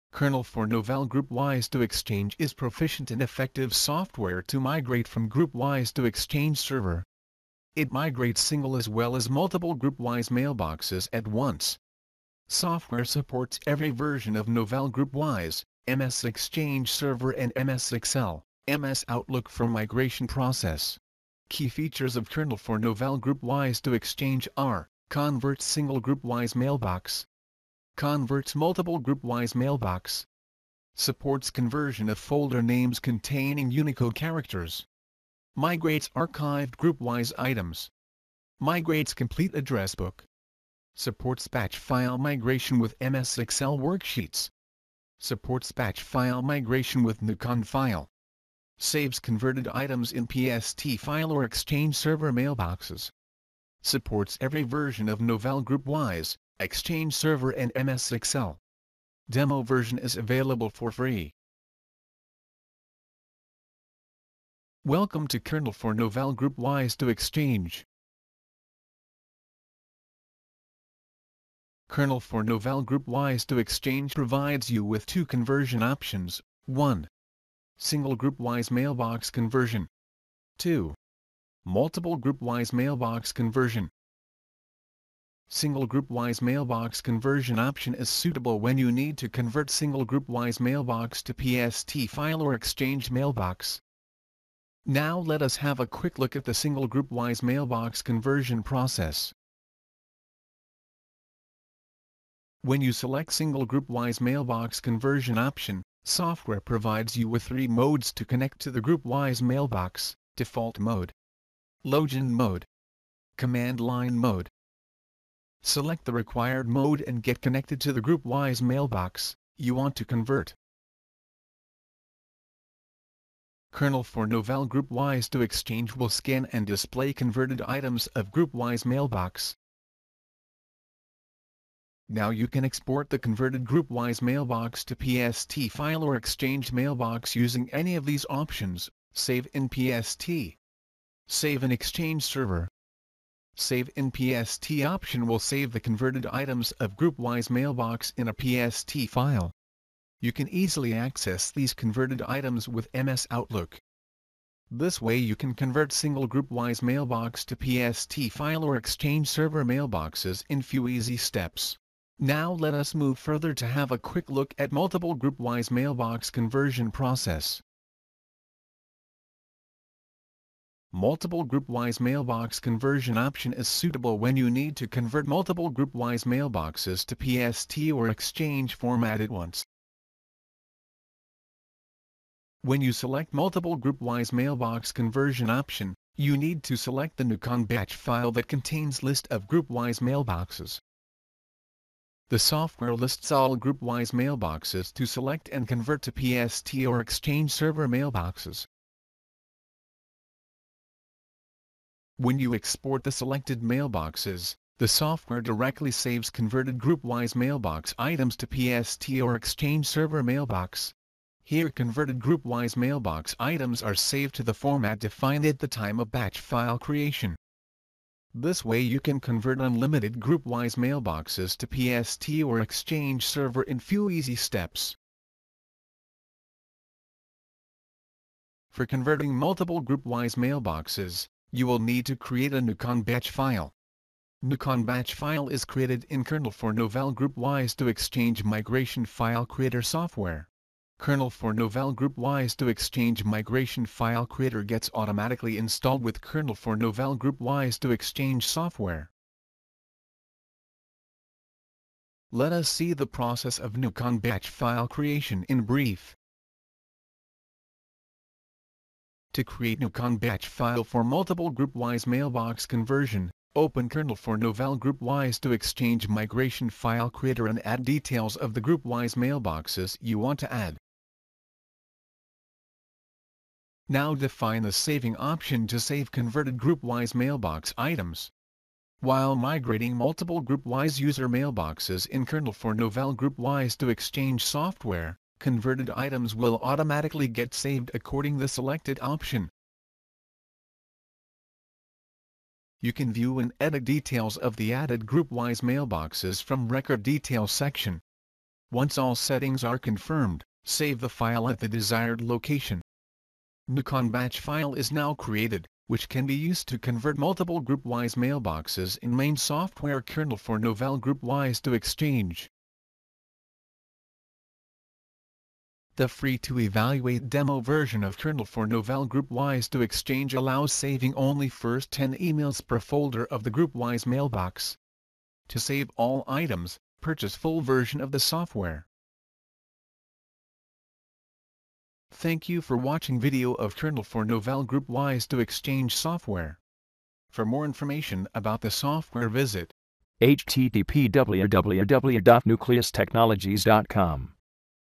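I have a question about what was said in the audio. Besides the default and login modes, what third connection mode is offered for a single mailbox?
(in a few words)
command line mode.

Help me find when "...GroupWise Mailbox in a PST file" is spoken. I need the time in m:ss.
2:26.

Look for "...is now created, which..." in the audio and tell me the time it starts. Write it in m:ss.
5:04.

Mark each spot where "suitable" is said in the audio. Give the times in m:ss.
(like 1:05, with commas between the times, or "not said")
1:28, 2:53.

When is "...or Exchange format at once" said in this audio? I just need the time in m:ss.
2:57.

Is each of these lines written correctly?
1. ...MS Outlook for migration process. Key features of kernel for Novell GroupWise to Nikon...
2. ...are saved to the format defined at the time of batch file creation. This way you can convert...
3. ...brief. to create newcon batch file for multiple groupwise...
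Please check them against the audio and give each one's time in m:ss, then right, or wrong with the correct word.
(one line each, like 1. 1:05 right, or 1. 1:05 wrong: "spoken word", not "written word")
1. 0:18 wrong: "Exchange", not "Nikon"
2. 3:33 right
3. 4:15 right.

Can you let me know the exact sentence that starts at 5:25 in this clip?
To save all items, purchase full version of the software.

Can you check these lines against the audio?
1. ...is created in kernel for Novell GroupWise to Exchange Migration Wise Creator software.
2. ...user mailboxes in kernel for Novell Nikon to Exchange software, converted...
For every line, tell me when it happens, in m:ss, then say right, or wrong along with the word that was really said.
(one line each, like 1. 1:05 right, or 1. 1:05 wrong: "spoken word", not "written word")
1. 3:55 wrong: "File", not "Wise"
2. 4:40 wrong: "GroupWise", not "Nikon".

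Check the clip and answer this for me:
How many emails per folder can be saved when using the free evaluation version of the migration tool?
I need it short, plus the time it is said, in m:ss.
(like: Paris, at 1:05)
10, at 5:21.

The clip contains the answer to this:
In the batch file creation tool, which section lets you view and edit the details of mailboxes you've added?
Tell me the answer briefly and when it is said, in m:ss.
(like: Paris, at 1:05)
Record Details, at 4:56.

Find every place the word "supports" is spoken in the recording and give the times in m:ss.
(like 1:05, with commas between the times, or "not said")
0:13, 0:30, 0:40, 0:45, 0:53.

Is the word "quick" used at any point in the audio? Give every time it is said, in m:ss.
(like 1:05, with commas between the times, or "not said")
1:35, 2:43.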